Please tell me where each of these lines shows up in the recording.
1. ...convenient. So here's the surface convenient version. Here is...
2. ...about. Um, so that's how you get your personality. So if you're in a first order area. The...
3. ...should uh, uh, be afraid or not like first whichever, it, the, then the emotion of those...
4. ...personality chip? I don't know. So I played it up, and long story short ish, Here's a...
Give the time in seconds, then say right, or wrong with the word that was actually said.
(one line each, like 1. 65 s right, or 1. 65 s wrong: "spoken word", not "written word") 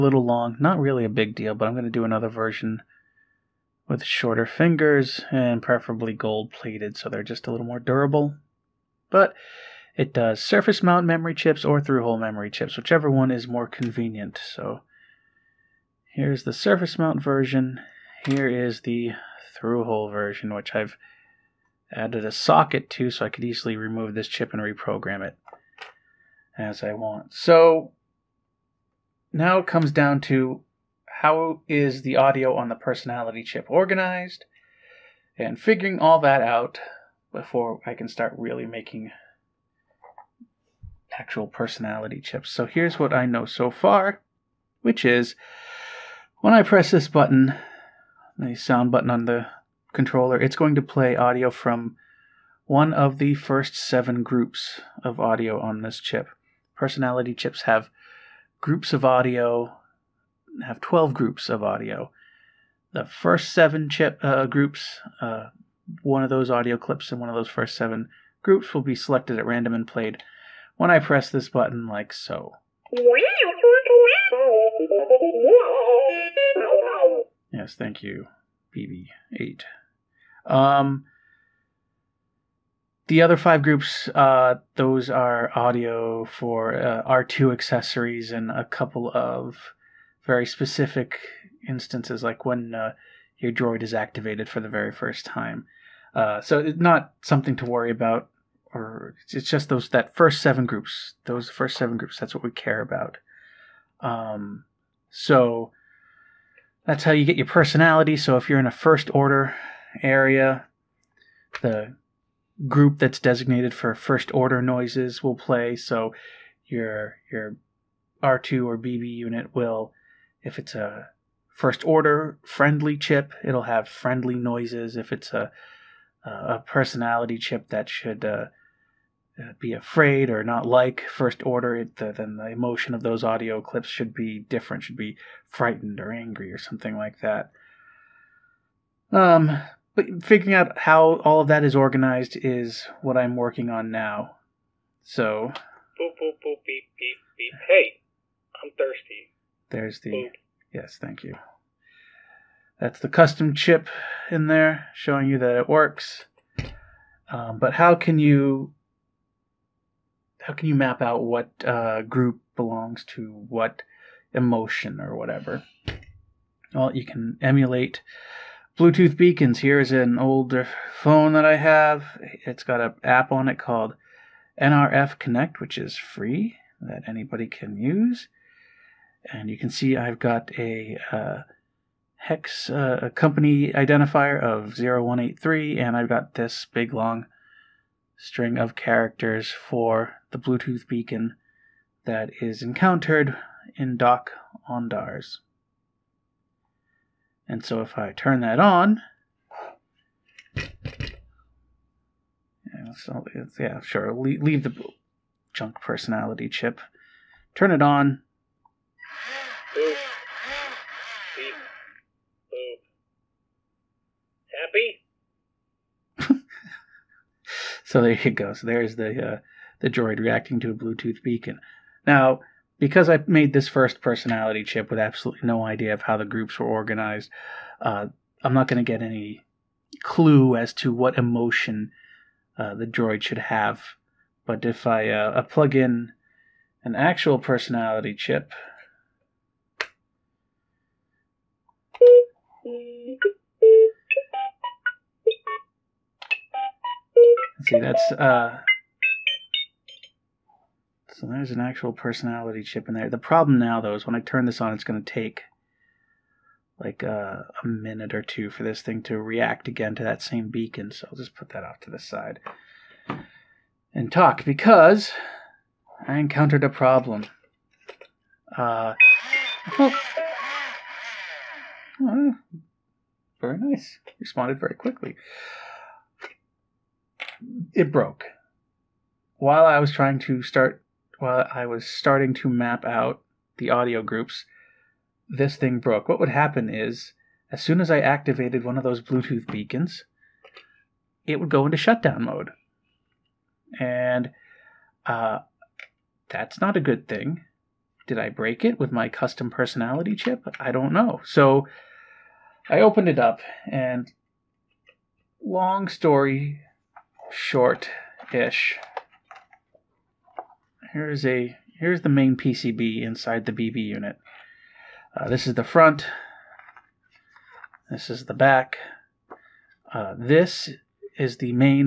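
1. 13 s wrong: "mount", not "convenient"
2. 102 s right
3. 127 s wrong: "order", not "whichever"
4. 299 s wrong: "opened", not "played".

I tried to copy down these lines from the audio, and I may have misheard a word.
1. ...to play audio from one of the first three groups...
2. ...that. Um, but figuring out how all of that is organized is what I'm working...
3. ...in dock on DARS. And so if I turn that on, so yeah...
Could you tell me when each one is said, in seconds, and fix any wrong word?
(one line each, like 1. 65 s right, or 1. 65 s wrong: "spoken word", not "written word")
1. 50 s wrong: "seven", not "three"
2. 137 s right
3. 193 s right.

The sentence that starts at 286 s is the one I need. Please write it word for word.
What would happen is, as soon as I activated one of those Bluetooth beacons, it would go into shutdown mode.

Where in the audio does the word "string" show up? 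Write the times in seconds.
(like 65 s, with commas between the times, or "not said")
188 s.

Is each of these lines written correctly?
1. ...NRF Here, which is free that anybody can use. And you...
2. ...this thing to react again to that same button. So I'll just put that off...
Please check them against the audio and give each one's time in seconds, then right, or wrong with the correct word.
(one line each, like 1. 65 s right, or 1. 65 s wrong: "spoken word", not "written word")
1. 174 s wrong: "Connect", not "Here"
2. 258 s wrong: "beacon", not "button".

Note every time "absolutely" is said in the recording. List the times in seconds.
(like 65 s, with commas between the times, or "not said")
224 s.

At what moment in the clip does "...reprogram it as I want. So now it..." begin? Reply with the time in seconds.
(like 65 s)
24 s.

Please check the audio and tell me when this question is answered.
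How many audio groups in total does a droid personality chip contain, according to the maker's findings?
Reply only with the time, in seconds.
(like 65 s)
60 s.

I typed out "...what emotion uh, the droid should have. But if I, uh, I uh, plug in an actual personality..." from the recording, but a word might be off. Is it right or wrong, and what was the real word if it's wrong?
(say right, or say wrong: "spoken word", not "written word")
right.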